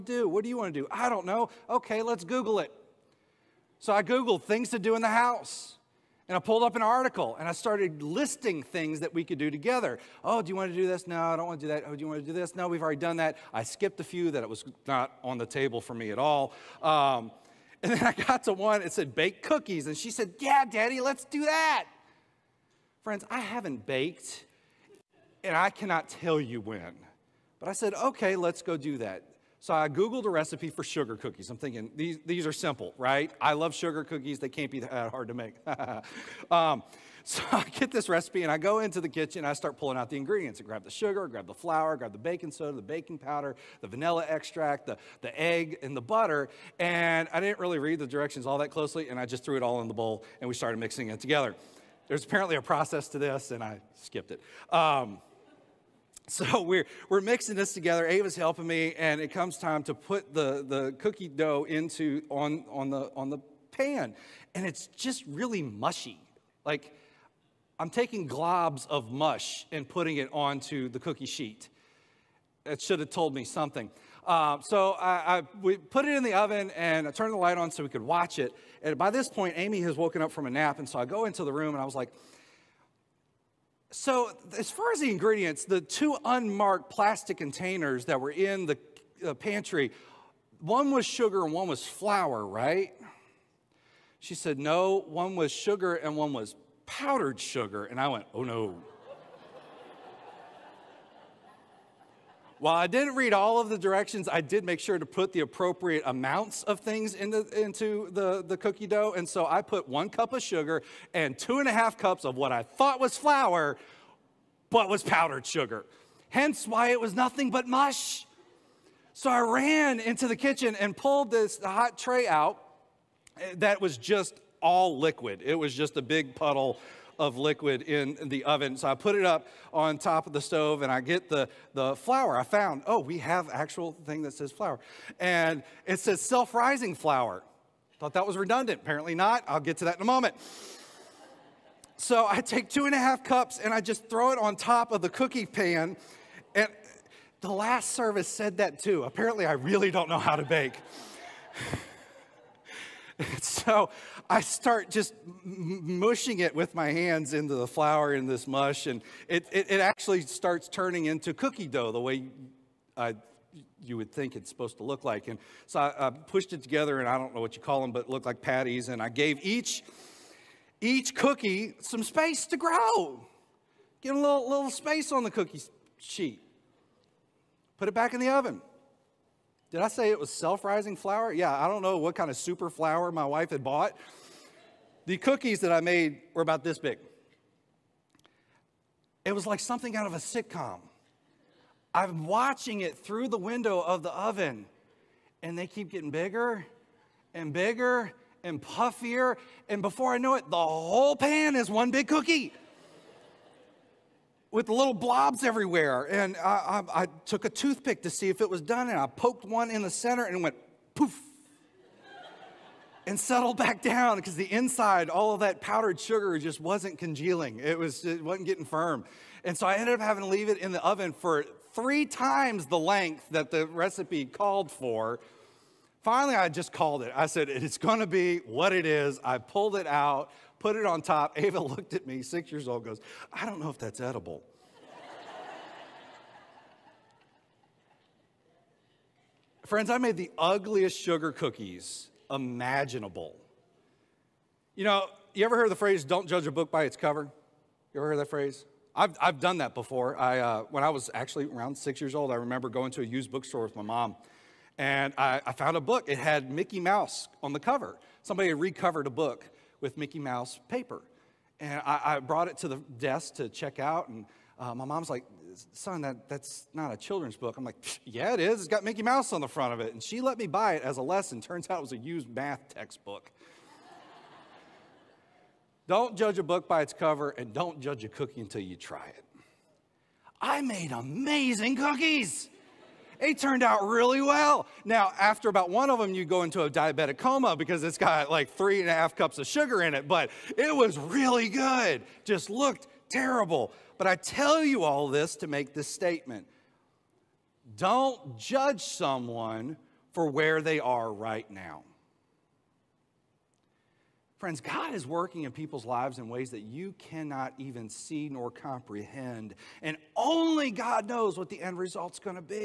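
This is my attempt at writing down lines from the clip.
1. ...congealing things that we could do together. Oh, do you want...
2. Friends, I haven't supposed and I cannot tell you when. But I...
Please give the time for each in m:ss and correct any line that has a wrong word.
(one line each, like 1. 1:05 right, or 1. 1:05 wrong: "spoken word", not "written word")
1. 0:08 wrong: "listing", not "congealing"
2. 0:23 wrong: "baked", not "supposed".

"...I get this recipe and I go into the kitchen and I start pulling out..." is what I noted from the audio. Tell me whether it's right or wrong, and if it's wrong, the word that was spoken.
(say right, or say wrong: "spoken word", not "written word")
right.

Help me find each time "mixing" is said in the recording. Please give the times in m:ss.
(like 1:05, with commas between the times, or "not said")
0:50, 0:57.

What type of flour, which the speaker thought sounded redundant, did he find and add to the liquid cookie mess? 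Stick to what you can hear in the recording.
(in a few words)
Self-rising flour.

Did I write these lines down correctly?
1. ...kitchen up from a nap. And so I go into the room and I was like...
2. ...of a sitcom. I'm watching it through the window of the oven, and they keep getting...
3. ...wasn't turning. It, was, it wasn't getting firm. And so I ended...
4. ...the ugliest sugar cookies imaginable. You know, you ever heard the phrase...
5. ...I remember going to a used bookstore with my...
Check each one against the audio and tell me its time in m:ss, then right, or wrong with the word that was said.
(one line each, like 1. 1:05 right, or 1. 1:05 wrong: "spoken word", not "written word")
1. 1:19 wrong: "woken", not "kitchen"
2. 3:10 right
3. 3:36 wrong: "congealing", not "turning"
4. 4:00 right
5. 4:12 right.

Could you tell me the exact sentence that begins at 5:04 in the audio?
Friends, God is working in people's lives in ways that you cannot even see nor comprehend.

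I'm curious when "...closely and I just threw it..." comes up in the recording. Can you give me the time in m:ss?
0:48.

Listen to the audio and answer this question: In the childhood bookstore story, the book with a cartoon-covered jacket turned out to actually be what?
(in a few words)
A used math textbook.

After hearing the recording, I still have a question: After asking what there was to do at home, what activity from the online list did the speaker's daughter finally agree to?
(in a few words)
Bake cookies.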